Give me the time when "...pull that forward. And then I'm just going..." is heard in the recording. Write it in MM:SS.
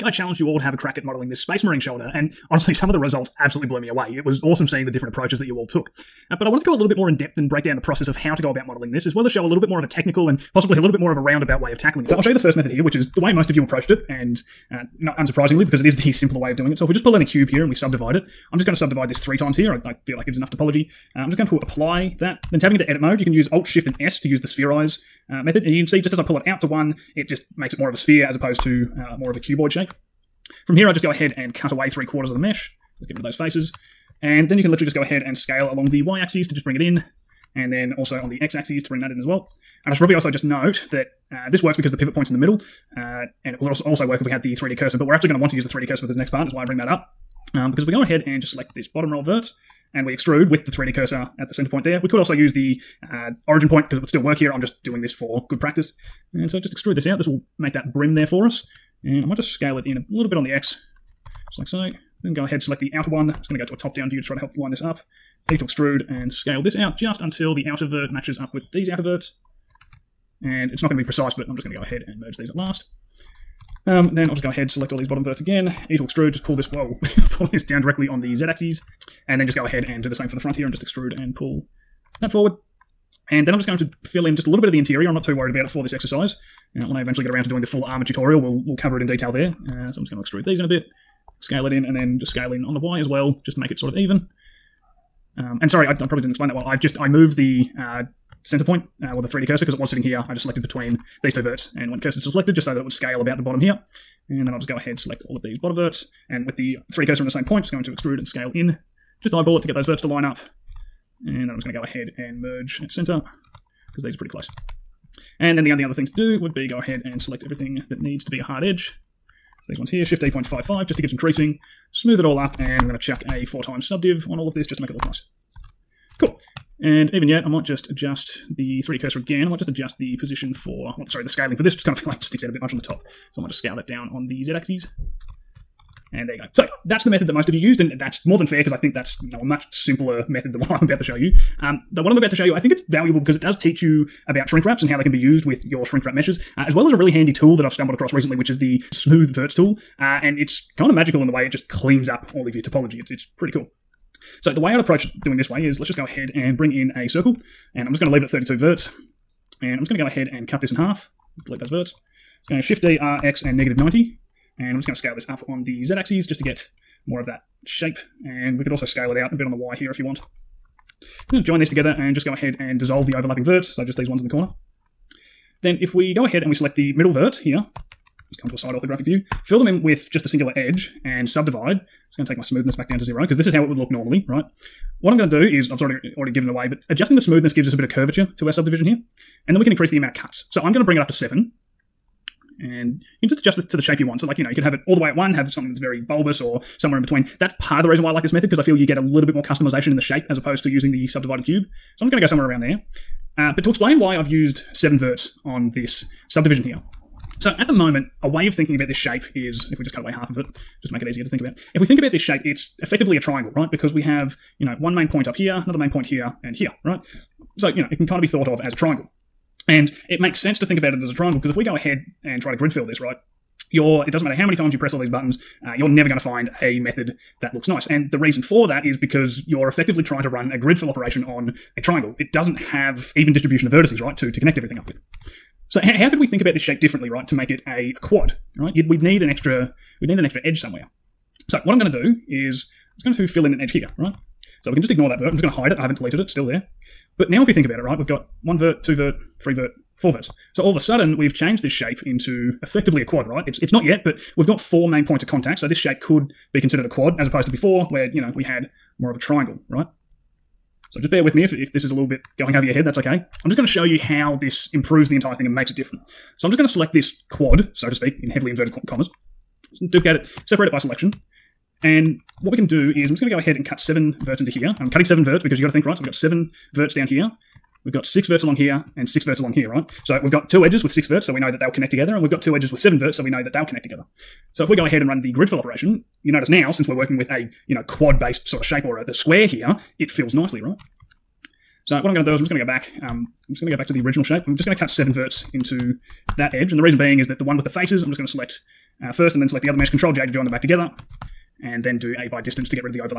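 01:21.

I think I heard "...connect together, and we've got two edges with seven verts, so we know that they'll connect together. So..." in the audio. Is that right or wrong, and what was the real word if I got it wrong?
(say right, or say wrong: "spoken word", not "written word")
right.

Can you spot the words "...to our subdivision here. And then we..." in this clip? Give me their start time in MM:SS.
03:08.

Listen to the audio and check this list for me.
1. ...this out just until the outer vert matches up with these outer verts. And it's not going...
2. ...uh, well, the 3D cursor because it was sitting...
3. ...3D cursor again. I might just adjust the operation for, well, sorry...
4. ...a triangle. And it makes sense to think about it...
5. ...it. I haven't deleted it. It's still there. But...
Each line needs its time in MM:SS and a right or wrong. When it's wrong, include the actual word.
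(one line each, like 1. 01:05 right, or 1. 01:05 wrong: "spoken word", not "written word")
1. 01:06 right
2. 01:39 right
3. 02:08 wrong: "position", not "operation"
4. 03:38 right
5. 04:05 right.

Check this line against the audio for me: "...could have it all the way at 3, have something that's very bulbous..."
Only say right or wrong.
wrong.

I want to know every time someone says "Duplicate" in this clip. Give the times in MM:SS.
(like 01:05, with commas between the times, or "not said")
04:29.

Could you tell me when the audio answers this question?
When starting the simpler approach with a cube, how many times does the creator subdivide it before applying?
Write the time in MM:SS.
00:19.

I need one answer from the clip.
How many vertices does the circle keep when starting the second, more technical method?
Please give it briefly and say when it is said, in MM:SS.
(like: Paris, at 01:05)
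32, at 02:38.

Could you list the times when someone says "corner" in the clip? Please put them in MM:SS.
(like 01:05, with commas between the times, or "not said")
02:54.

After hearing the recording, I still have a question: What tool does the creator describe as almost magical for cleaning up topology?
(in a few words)
Smooth Verts.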